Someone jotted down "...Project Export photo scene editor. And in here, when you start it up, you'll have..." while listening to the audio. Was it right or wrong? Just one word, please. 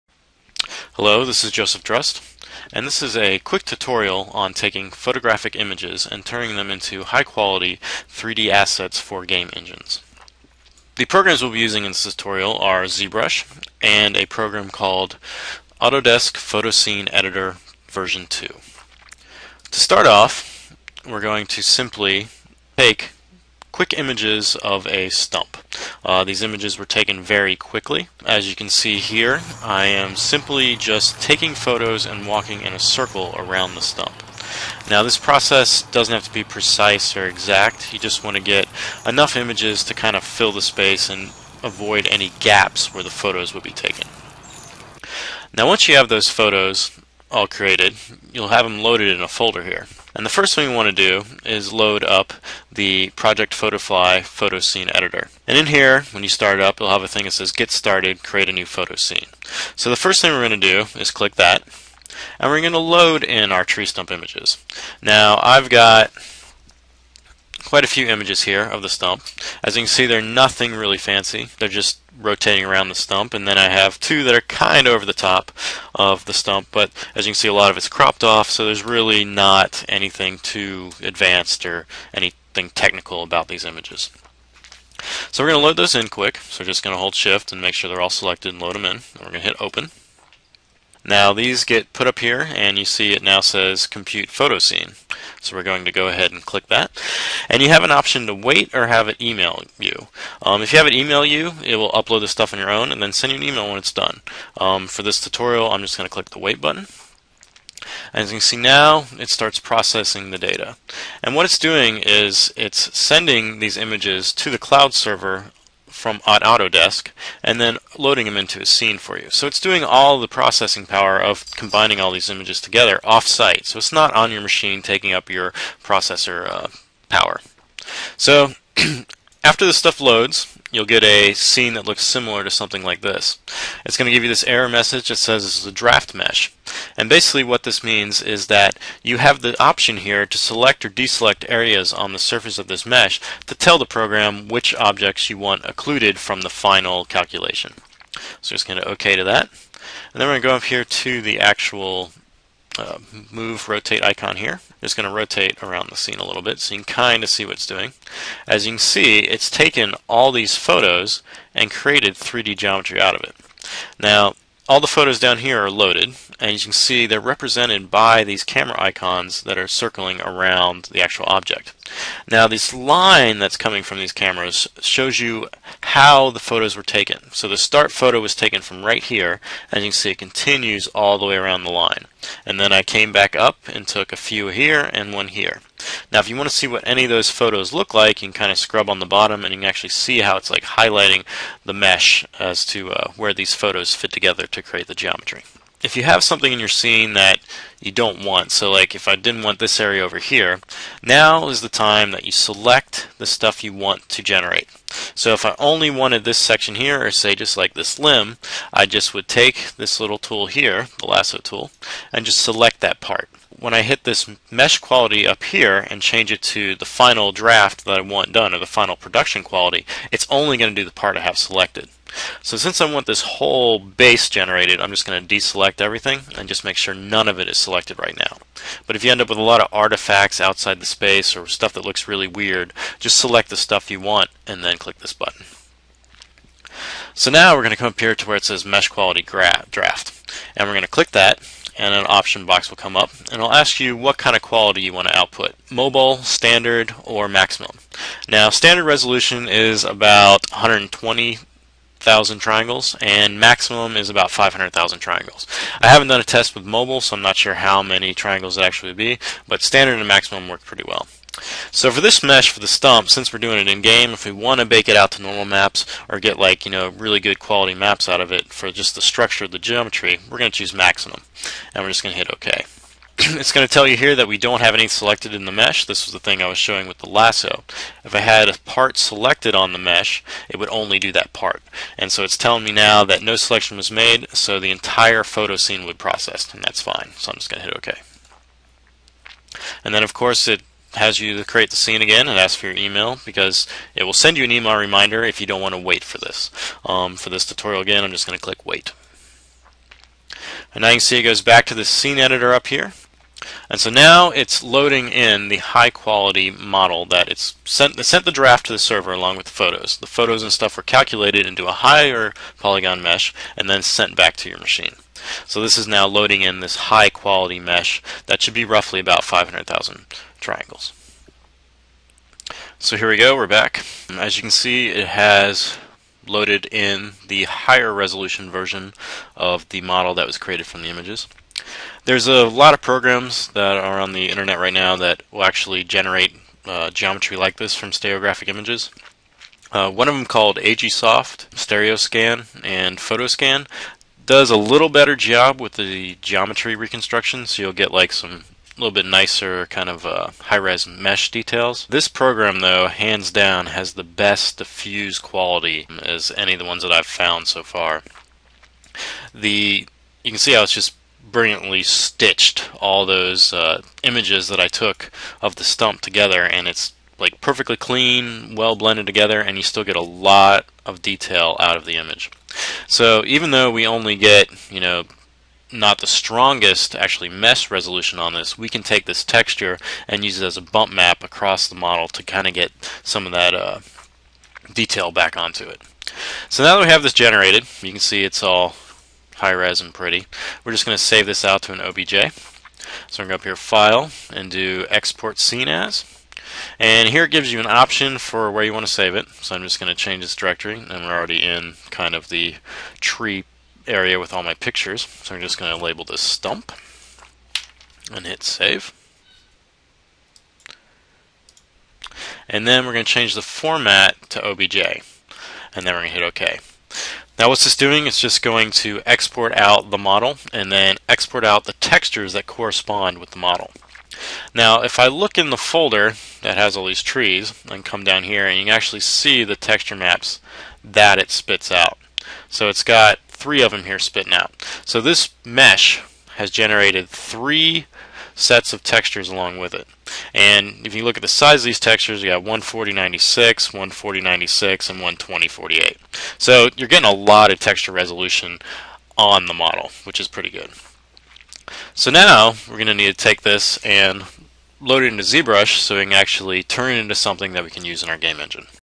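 wrong.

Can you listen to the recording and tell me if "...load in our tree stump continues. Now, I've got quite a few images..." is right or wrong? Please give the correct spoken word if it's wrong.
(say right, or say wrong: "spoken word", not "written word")
wrong: "images", not "continues".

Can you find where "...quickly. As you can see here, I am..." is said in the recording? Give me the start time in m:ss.
0:27.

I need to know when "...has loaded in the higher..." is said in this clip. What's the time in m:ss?
5:25.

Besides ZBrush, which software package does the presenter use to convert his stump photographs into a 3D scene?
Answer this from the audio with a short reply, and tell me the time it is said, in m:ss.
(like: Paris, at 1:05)
Autodesk Photoscene Editor, at 0:15.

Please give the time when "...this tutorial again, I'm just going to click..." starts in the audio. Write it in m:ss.
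4:57.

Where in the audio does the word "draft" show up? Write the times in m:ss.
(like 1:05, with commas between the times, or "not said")
2:15, 3:37, 3:59, 5:08.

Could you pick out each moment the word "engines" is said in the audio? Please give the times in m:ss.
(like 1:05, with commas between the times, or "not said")
0:09, 7:38.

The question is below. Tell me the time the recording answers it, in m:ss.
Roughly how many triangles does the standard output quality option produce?
4:10.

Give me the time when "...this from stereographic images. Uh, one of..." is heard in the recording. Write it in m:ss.
5:37.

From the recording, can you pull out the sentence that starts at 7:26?
So you're getting a lot of texture resolution on the model, which is pretty good.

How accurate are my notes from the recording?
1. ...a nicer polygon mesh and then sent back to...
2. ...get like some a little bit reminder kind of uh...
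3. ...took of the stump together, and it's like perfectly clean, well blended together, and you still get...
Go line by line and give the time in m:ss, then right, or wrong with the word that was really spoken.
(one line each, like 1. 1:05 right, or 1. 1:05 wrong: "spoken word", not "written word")
1. 5:11 wrong: "higher", not "nicer"
2. 5:47 wrong: "nicer", not "reminder"
3. 6:04 right.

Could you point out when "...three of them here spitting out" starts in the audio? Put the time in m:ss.
7:13.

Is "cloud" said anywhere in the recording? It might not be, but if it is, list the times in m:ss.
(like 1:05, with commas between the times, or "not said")
1:54.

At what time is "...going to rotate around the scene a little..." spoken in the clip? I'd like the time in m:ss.
2:34.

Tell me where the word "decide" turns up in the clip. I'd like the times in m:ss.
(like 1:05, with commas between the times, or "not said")
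not said.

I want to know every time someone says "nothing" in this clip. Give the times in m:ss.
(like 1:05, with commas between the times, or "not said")
1:10.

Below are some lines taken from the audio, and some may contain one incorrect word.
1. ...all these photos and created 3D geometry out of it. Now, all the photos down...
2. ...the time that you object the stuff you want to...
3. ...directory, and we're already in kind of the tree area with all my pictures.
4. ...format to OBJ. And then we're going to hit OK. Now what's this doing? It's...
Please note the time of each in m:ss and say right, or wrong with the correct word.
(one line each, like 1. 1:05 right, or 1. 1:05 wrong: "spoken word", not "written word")
1. 2:40 right
2. 3:21 wrong: "select", not "object"
3. 6:40 right
4. 6:53 right.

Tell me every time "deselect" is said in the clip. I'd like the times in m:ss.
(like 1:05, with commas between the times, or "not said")
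2:20, 3:45.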